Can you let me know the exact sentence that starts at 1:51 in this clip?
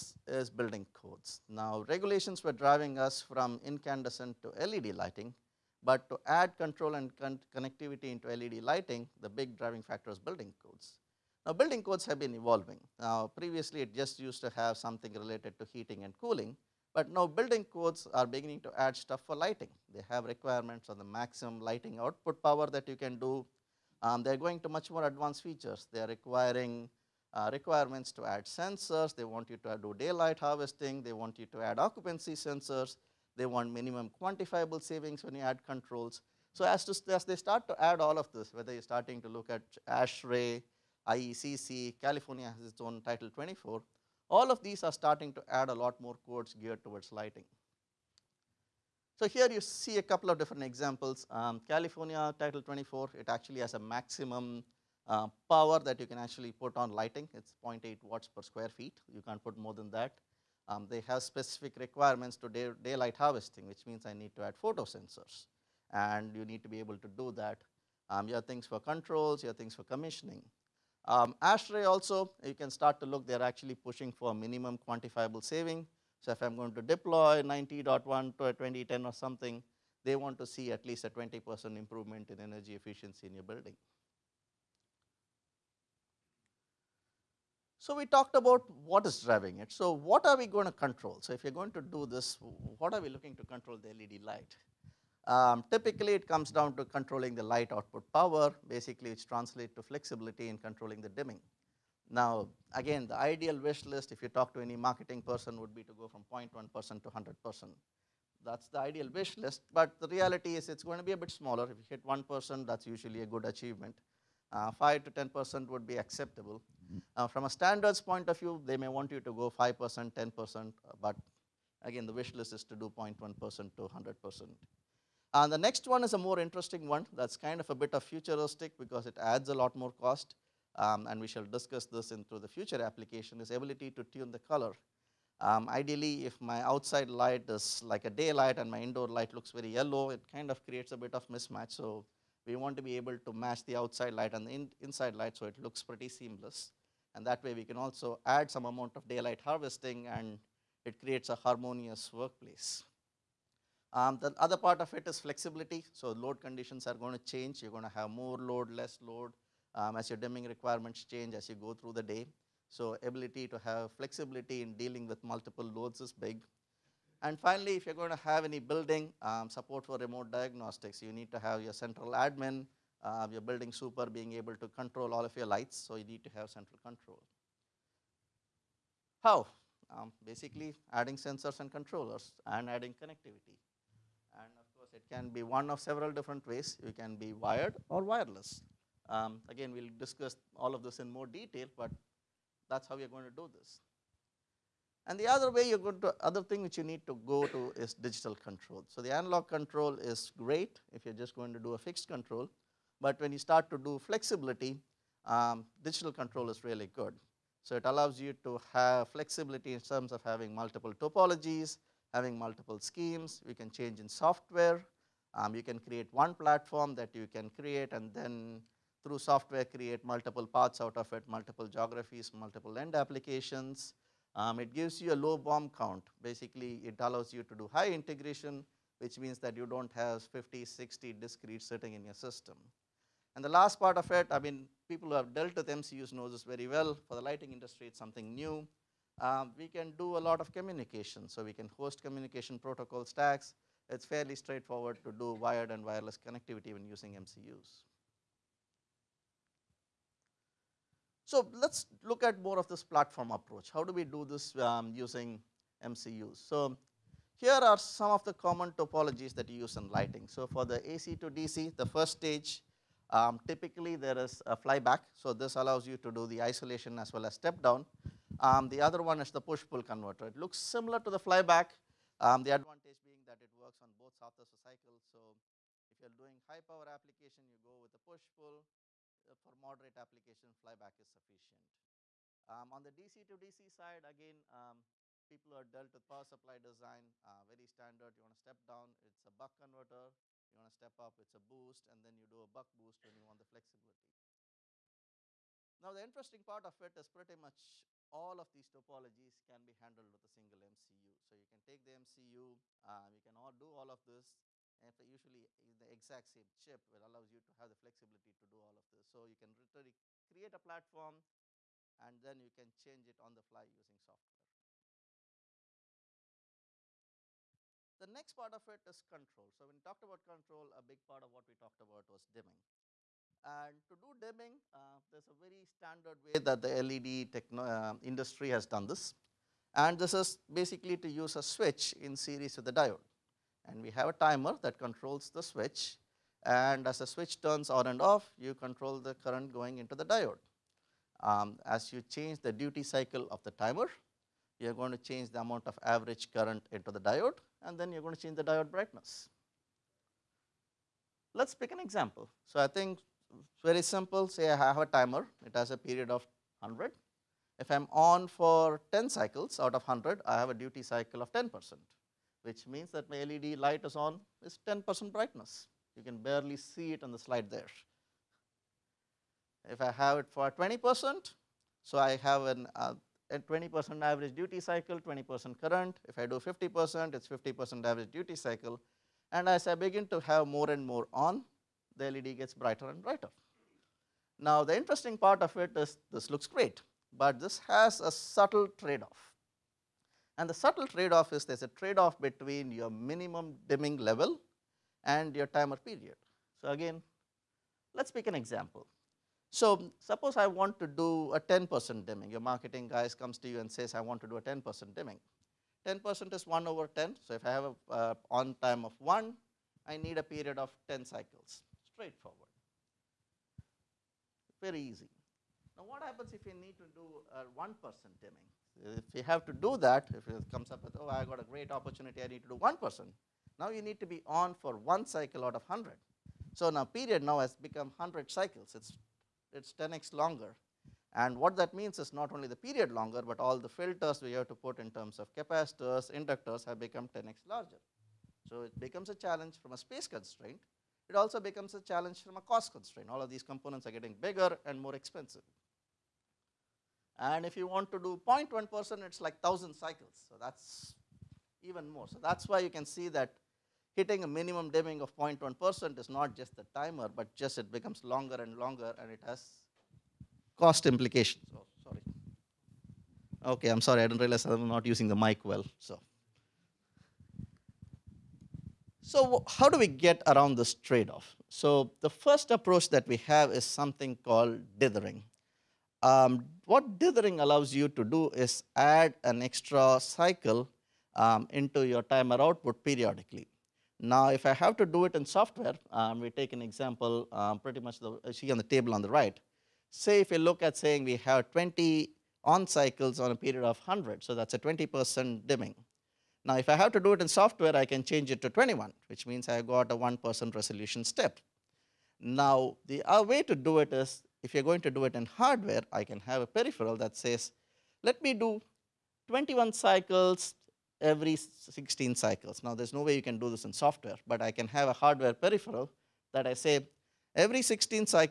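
If you hit 1%, that's usually a good achievement.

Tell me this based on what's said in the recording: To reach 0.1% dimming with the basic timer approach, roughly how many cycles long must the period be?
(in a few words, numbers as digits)
1000 cycles.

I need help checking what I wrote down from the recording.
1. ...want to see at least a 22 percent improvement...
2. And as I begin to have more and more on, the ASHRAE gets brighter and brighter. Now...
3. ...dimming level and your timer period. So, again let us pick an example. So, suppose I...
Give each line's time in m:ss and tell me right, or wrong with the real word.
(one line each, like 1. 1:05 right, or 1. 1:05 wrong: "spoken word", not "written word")
1. 1:20 wrong: "20", not "22"
2. 6:19 wrong: "LED", not "ASHRAE"
3. 6:33 right.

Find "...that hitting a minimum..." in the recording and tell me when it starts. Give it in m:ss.
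7:33.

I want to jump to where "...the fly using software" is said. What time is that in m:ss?
5:13.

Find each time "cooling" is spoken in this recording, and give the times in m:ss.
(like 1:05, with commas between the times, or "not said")
0:16.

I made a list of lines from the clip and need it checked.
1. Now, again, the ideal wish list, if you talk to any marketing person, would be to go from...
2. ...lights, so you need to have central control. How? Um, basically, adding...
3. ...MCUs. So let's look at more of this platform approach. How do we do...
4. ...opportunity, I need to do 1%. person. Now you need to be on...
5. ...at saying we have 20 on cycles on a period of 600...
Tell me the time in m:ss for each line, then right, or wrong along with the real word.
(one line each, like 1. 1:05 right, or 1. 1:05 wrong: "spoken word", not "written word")
1. 1:42 right
2. 2:55 right
3. 4:07 right
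4. 7:01 right
5. 8:10 wrong: "100", not "600".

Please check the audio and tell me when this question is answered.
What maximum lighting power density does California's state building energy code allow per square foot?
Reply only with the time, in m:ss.
0:57.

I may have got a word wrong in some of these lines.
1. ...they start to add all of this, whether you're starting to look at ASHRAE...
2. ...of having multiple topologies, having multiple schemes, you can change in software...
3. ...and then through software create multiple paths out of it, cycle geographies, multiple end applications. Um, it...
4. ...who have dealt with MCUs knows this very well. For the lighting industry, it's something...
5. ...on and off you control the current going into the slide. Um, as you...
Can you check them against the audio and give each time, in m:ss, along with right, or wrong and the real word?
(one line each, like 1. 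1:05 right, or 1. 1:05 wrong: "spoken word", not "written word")
1. 0:37 right
2. 3:30 right
3. 3:37 wrong: "multiple", not "cycle"
4. 3:55 right
5. 5:37 wrong: "diode", not "slide".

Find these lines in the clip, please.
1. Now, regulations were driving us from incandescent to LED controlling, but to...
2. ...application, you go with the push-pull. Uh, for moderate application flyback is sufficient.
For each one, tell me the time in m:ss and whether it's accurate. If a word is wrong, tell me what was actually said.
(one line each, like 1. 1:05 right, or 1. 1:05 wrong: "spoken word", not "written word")
1. 0:01 wrong: "lighting", not "controlling"
2. 4:36 right.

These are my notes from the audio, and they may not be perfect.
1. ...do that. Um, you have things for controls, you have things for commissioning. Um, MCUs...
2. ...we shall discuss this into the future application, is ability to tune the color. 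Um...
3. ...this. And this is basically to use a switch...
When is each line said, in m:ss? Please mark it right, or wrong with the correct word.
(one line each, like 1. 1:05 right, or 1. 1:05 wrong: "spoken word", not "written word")
1. 1:07 wrong: "ASHRAE", not "MCUs"
2. 2:11 right
3. 5:28 right.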